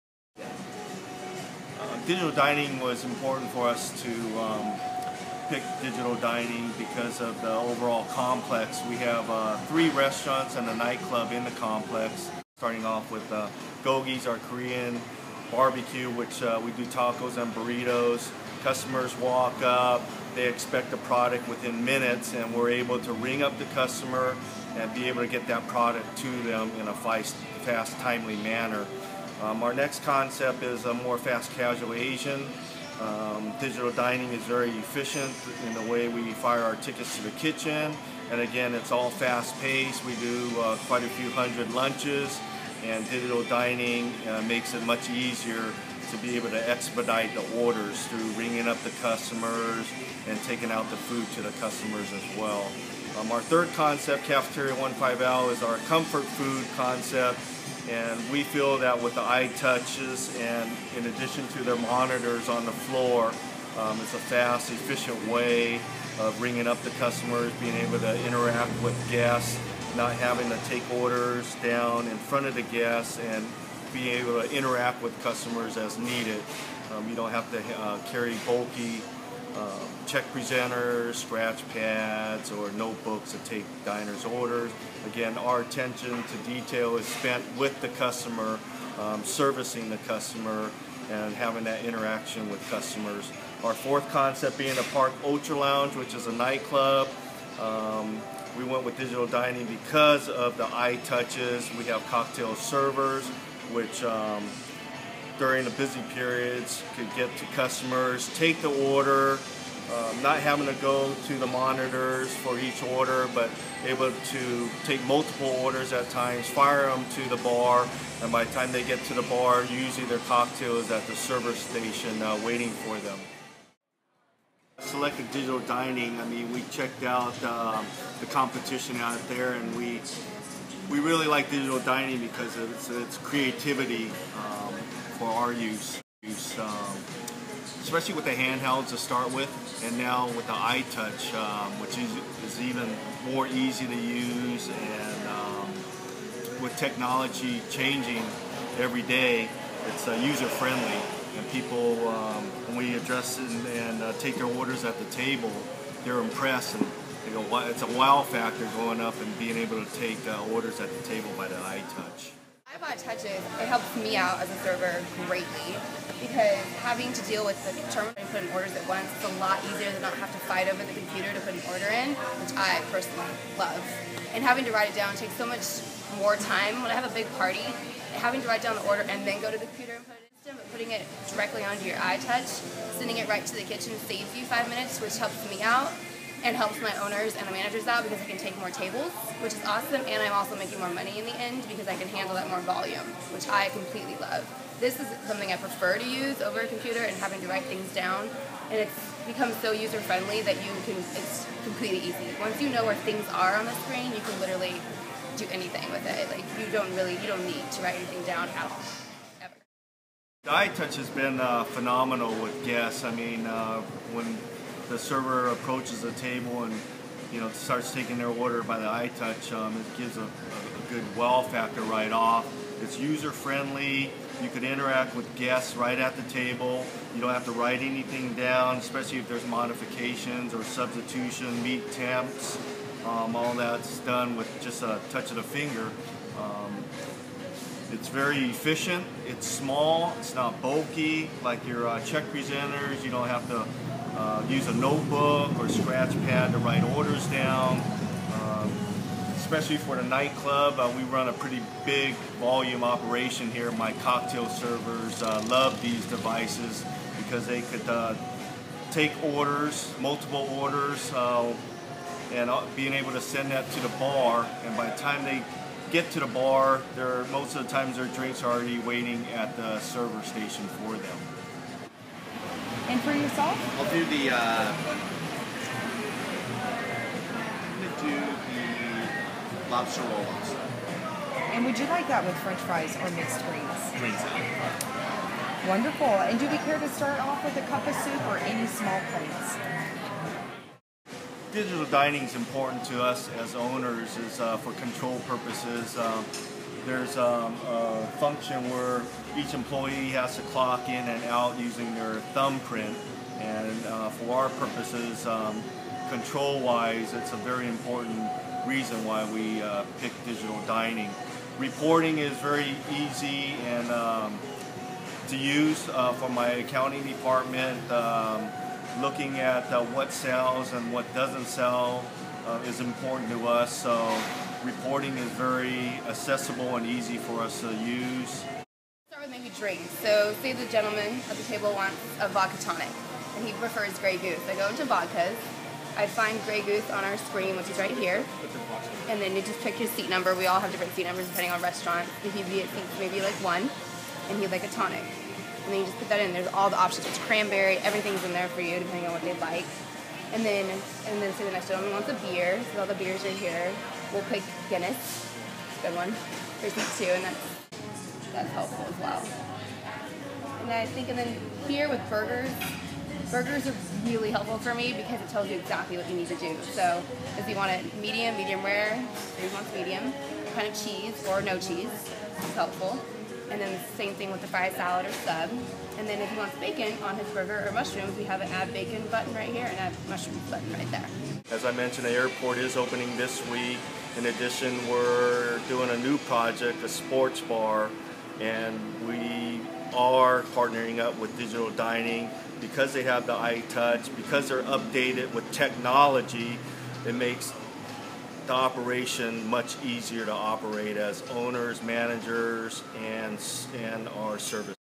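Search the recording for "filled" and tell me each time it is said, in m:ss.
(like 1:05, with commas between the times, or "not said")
not said.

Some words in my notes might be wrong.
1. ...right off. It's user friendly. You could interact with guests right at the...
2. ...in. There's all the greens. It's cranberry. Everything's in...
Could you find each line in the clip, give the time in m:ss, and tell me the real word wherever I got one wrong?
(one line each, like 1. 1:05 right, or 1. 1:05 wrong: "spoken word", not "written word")
1. 3:41 right
2. 5:46 wrong: "options", not "greens".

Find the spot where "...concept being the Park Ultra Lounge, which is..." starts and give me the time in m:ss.
1:34.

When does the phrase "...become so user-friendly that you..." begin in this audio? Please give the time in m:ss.
3:19.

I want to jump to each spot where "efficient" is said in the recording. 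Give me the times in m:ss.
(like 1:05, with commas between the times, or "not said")
0:34, 1:04, 3:58.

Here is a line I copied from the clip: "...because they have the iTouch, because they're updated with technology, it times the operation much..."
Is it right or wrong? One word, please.
wrong.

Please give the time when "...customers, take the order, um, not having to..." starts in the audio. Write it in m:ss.
1:47.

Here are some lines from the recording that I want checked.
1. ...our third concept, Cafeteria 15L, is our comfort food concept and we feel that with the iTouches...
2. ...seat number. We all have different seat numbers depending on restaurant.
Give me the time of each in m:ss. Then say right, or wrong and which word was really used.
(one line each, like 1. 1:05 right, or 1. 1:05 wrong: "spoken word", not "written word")
1. 0:53 right
2. 5:39 right.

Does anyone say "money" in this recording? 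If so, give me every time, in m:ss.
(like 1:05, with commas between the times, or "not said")
3:10.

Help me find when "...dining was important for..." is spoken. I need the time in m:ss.
0:02.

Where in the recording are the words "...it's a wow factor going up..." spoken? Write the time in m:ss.
2:37.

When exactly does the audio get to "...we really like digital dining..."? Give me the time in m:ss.
2:10.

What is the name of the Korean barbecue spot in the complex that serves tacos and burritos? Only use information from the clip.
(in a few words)
Gogi's.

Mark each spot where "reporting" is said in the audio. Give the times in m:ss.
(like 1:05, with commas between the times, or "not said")
5:11, 5:24.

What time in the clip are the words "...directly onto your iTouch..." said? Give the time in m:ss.
3:01.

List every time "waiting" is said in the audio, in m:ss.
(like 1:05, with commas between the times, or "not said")
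2:02, 4:28.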